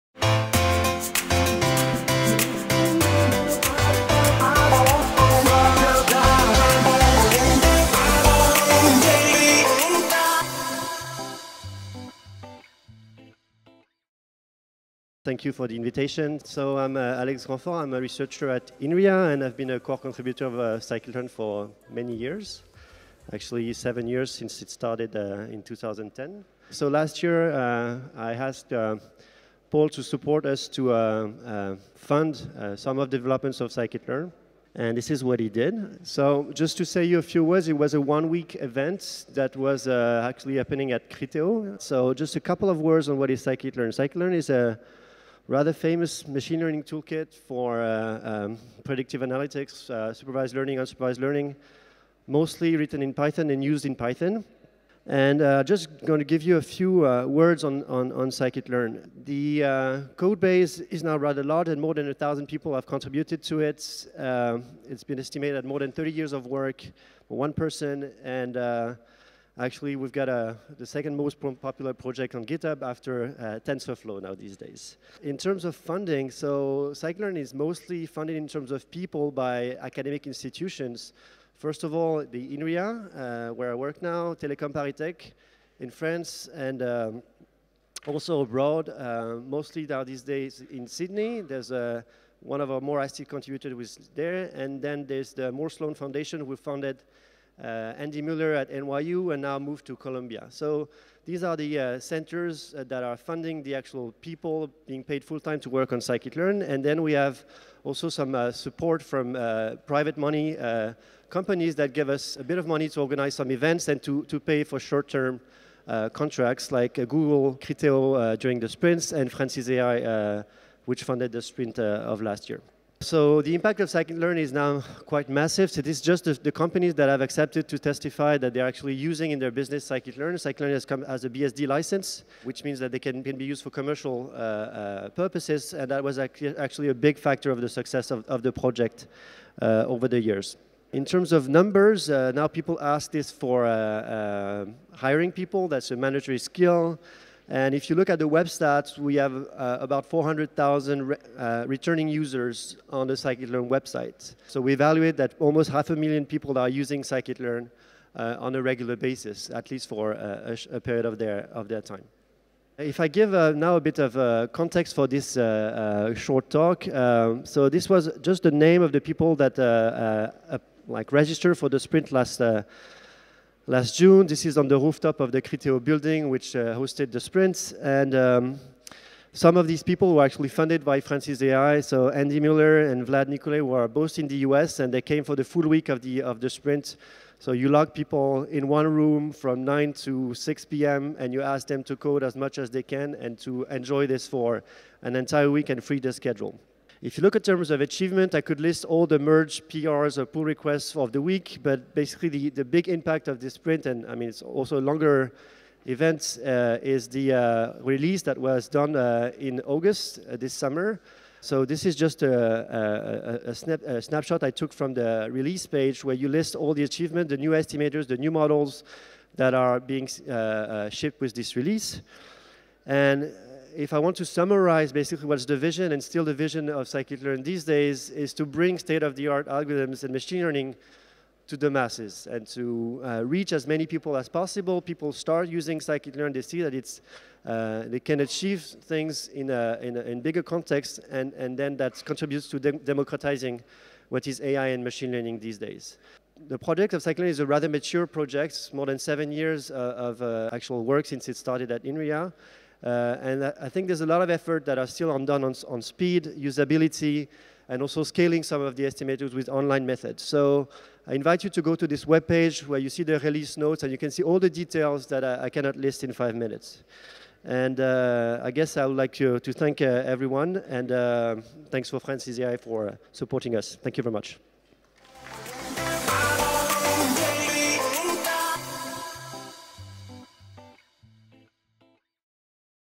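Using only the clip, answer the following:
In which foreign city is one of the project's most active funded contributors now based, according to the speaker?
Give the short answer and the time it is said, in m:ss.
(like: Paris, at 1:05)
Sydney, at 1:30.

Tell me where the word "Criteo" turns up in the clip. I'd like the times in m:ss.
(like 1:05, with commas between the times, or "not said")
0:41, 1:57, 2:55.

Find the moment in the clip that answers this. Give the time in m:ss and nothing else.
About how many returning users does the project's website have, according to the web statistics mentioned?
2:30.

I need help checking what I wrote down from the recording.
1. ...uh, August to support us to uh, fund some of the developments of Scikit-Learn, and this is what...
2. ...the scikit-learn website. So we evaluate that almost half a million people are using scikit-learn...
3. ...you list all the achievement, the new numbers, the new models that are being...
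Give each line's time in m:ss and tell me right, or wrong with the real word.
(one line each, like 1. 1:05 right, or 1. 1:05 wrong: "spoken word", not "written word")
1. 0:28 wrong: "Paul", not "August"
2. 2:33 right
3. 3:36 wrong: "estimators", not "numbers".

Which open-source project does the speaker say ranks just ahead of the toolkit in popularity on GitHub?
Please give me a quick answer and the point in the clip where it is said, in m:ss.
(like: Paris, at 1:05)
TensorFlow, at 1:13.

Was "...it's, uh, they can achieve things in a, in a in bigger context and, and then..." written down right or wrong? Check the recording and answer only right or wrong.
right.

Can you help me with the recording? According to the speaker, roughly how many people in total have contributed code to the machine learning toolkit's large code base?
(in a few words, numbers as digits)
more than 1,000.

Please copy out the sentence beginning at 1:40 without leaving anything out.
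So these are the uh, centers uh, that are funding the actual people being paid full-time to work on scikit-learn.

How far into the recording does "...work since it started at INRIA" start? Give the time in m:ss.
4:10.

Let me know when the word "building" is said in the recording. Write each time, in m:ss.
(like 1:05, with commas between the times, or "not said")
2:55.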